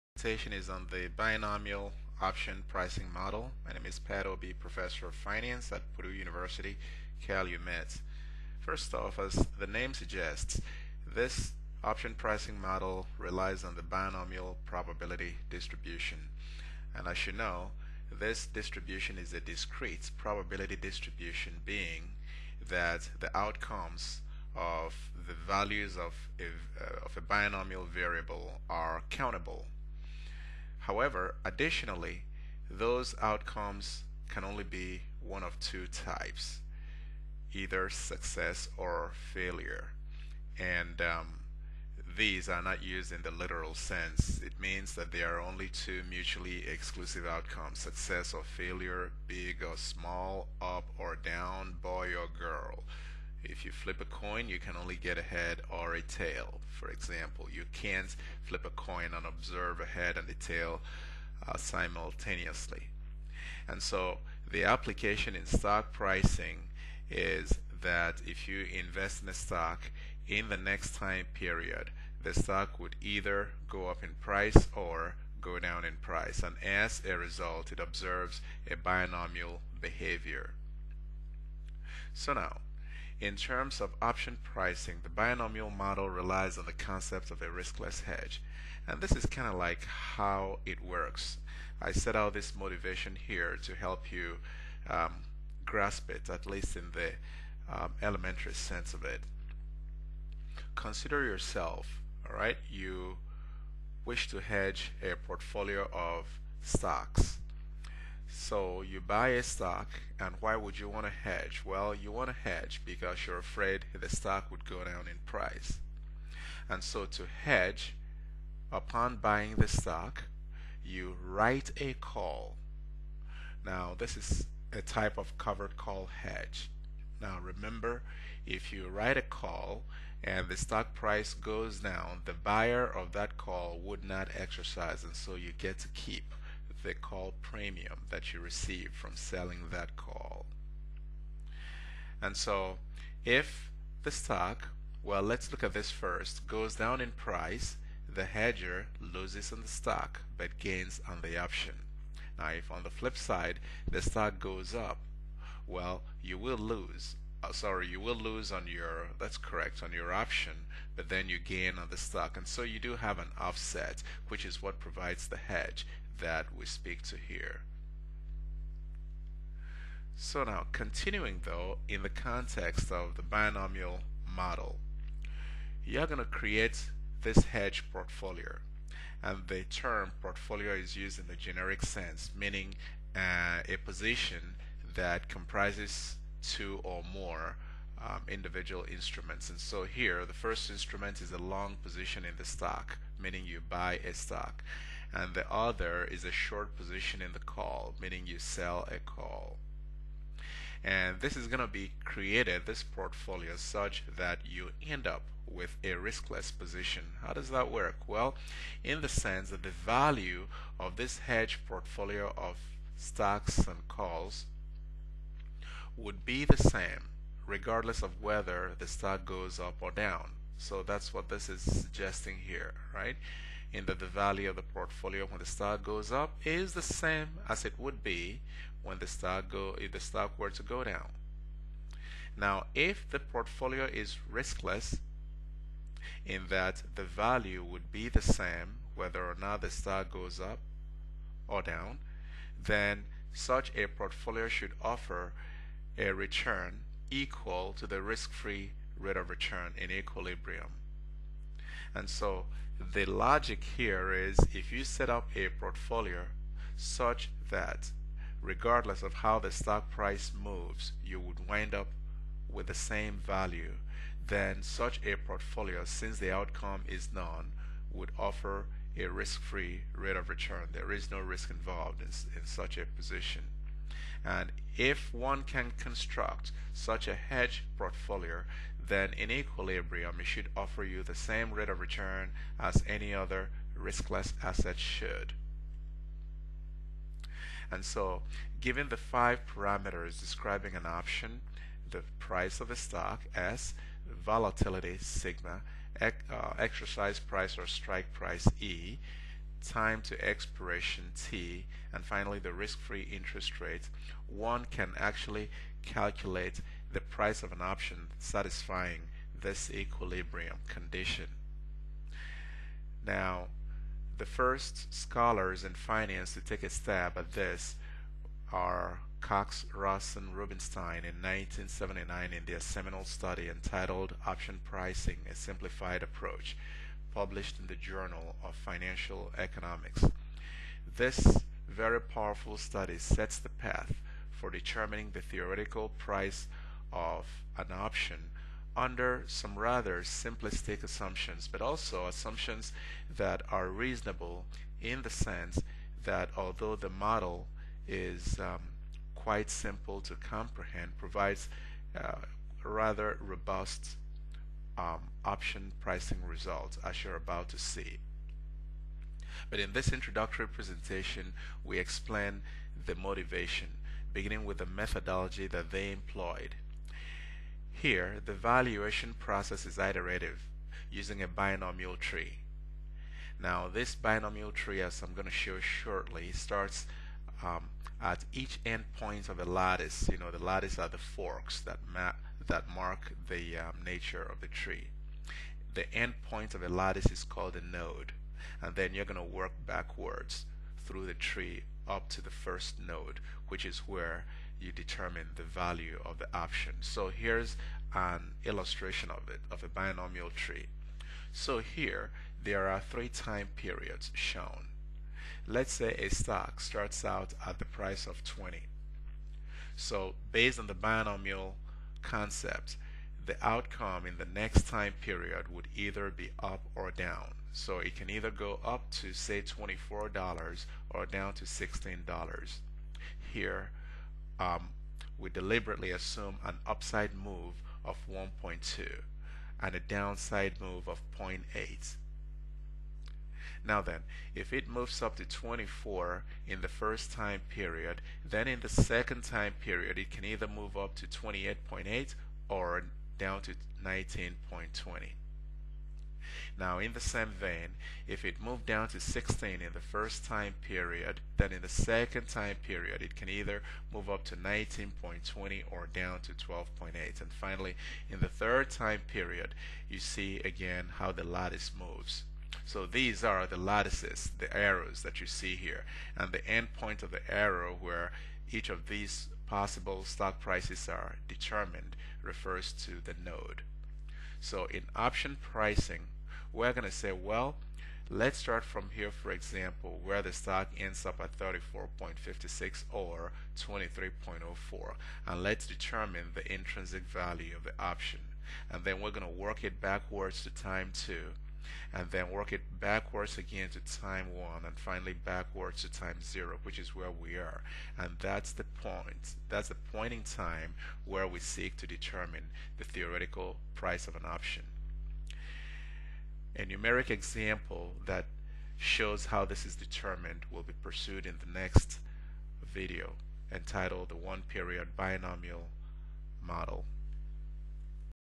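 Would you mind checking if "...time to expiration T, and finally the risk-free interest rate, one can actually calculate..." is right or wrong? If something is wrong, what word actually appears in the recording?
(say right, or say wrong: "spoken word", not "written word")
right.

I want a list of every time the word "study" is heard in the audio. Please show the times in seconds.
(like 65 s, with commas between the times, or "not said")
323 s, 332 s.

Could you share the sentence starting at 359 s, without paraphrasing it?
But in this introductory presentation, we explain the motivation, beginning with the methodology that they employed.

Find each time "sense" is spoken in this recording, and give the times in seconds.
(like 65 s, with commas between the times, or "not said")
43 s, 98 s, 181 s, 209 s, 345 s.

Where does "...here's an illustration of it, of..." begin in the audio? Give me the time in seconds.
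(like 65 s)
397 s.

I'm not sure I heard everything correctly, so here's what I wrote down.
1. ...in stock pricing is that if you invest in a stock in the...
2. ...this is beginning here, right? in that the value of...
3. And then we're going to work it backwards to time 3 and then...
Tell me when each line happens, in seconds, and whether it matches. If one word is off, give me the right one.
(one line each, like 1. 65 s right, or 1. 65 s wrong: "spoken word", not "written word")
1. 65 s right
2. 221 s wrong: "suggesting", not "beginning"
3. 488 s wrong: "2", not "3".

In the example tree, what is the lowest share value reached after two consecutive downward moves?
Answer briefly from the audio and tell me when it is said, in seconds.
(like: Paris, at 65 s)
12.8, at 456 s.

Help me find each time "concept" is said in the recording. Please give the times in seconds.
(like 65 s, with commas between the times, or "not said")
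86 s, 412 s.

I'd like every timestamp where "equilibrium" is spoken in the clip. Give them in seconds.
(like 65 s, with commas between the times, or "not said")
249 s, 279 s, 309 s.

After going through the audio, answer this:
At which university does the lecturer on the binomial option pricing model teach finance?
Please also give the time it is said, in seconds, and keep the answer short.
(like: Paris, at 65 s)
Purdue University, Calumet, at 5 s.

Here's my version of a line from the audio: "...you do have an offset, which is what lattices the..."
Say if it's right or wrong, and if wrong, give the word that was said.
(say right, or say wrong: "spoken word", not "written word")
wrong: "provides", not "lattices".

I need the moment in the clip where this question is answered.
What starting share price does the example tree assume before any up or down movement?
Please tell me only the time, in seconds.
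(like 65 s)
408 s.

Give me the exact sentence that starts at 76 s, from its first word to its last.
And as a result, it observes a binomial behavior.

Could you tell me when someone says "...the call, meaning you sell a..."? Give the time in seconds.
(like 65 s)
197 s.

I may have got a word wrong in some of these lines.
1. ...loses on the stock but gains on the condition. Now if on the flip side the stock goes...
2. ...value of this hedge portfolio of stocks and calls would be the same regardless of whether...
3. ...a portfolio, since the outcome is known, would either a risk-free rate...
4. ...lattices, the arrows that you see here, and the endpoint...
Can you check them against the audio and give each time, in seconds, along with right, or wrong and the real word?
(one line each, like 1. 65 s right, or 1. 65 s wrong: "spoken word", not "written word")
1. 148 s wrong: "option", not "condition"
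2. 209 s right
3. 265 s wrong: "offer", not "either"
4. 463 s right.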